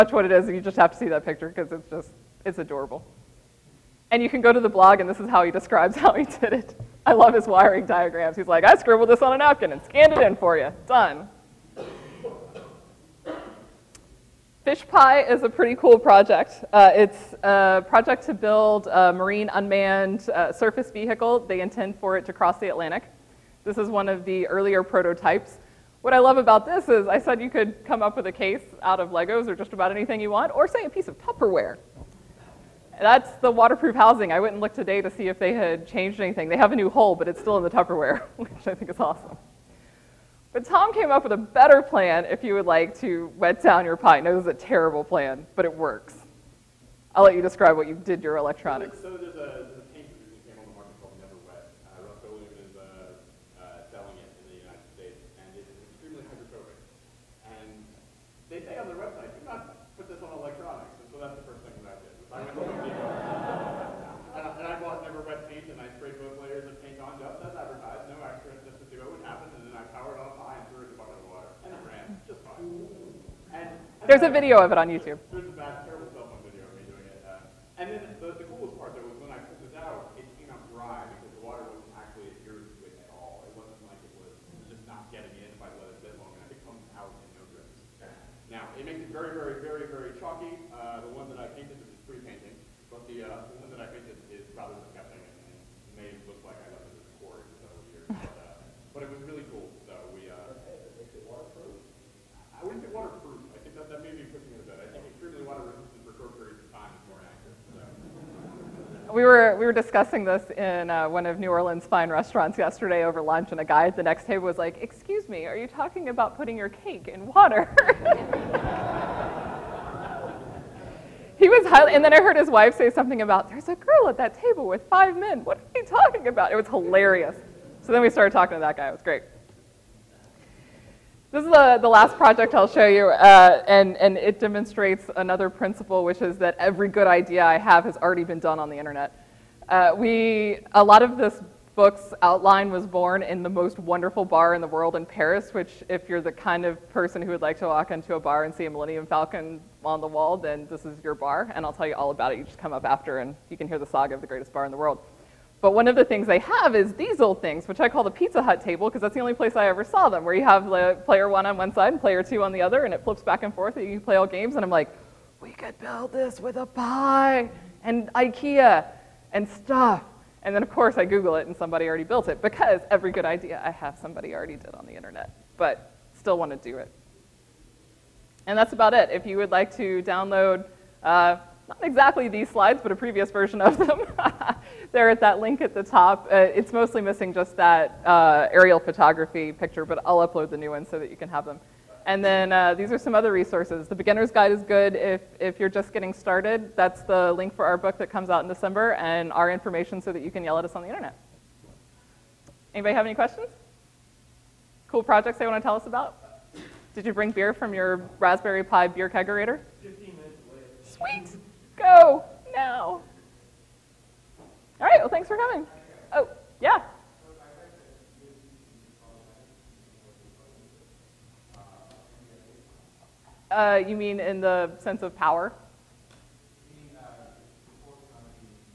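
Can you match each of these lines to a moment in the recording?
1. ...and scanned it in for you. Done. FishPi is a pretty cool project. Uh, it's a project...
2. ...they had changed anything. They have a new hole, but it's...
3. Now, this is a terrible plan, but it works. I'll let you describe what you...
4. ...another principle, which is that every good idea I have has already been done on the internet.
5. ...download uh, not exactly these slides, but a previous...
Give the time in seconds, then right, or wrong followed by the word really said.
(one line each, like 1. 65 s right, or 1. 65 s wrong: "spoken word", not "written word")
1. 9 s right
2. 35 s right
3. 44 s right
4. 135 s right
5. 180 s right.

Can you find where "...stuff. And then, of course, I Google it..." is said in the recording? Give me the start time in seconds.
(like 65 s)
169 s.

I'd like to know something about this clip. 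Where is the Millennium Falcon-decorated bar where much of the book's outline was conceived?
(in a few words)
Paris.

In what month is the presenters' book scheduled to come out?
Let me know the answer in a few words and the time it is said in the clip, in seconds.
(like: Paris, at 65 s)
December, at 198 s.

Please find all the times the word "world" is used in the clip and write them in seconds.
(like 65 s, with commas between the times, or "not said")
144 s, 154 s.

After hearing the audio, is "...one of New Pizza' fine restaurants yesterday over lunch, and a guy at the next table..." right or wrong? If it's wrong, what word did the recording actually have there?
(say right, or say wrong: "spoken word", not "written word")
wrong: "Orleans", not "Pizza".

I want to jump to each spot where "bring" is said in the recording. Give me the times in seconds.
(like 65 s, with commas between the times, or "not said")
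207 s.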